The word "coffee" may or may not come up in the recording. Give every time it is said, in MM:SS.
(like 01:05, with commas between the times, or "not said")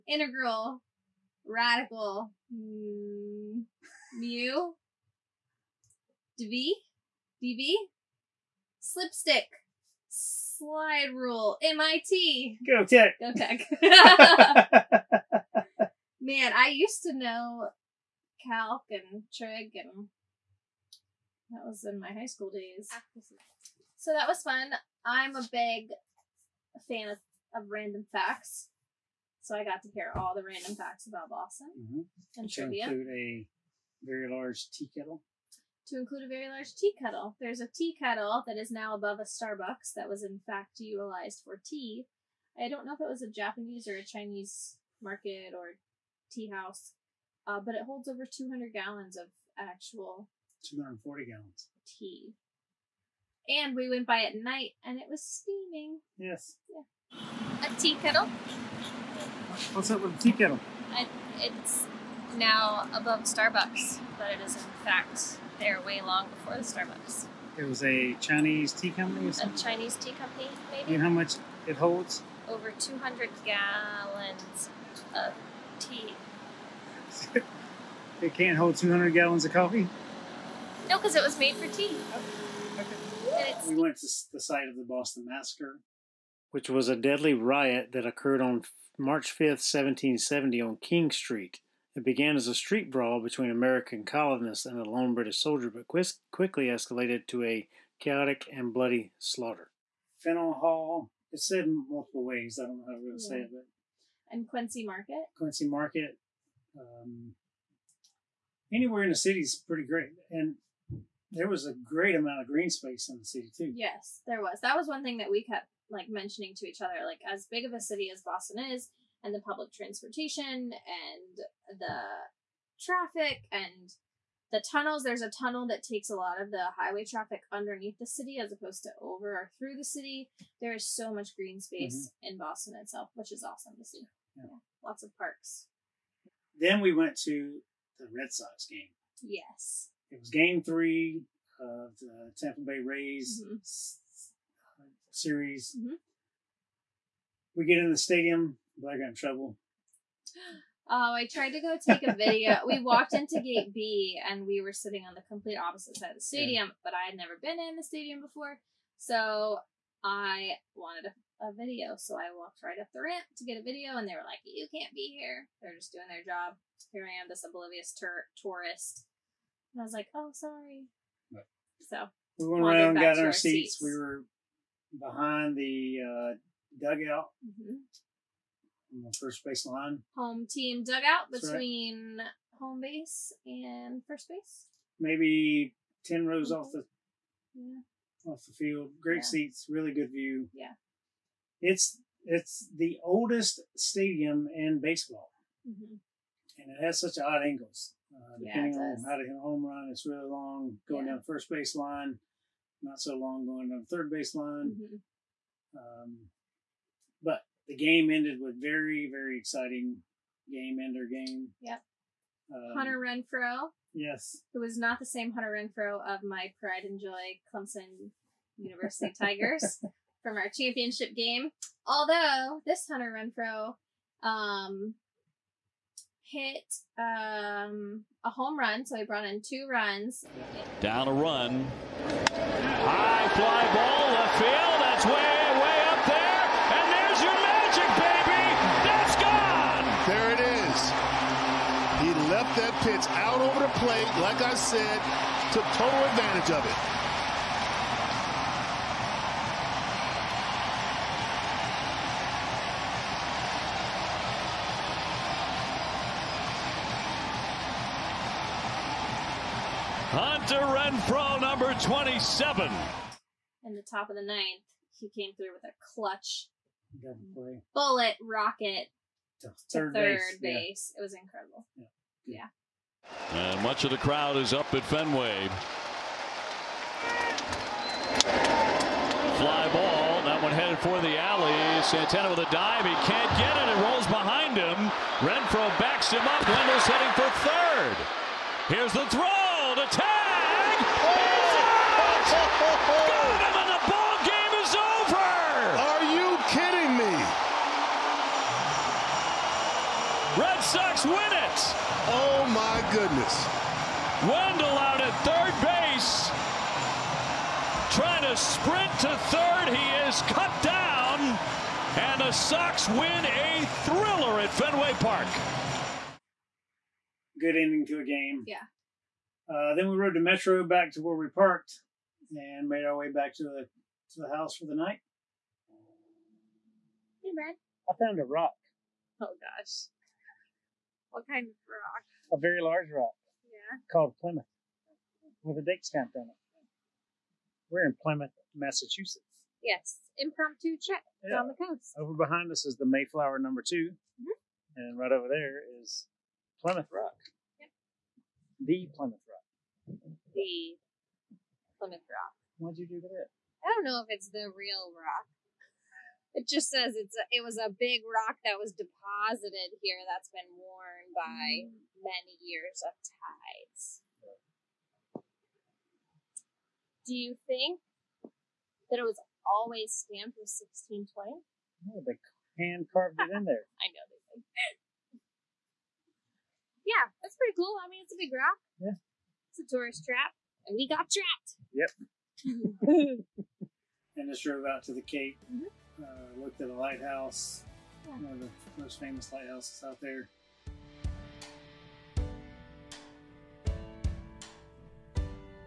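01:19.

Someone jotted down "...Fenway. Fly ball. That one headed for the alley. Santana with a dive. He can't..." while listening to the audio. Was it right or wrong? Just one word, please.
right.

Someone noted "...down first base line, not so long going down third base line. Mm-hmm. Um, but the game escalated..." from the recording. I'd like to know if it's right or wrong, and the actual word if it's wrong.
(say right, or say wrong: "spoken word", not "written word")
wrong: "ended", not "escalated".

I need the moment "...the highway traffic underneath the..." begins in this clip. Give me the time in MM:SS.
02:06.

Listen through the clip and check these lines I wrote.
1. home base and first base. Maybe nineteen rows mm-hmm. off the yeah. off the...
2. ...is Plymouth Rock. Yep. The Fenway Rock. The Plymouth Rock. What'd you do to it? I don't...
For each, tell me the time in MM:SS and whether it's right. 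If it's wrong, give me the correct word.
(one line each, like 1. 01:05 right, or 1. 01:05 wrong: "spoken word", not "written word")
1. 03:02 wrong: "ten", not "nineteen"
2. 05:45 wrong: "Plymouth", not "Fenway".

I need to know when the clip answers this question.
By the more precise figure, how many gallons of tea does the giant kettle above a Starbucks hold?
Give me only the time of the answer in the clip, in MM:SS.
00:50.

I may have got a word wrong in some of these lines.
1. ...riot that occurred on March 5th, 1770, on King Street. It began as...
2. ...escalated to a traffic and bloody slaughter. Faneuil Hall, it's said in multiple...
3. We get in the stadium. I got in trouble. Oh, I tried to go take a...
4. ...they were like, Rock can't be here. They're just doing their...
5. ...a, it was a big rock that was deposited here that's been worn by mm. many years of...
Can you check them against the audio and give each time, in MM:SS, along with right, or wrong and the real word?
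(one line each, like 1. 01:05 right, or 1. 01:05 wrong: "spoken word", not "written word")
1. 01:27 right
2. 01:36 wrong: "chaotic", not "traffic"
3. 02:27 right
4. 02:44 wrong: "You", not "Rock"
5. 05:57 right.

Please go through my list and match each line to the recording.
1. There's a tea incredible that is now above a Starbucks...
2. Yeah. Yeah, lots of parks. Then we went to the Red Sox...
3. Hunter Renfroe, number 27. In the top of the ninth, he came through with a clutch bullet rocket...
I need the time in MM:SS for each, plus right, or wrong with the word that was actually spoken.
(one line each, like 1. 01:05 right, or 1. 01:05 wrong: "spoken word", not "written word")
1. 00:37 wrong: "kettle", not "incredible"
2. 02:14 right
3. 04:20 right.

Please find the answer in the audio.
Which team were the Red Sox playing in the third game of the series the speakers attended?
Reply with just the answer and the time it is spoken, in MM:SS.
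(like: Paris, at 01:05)
Tampa Bay Rays, at 02:22.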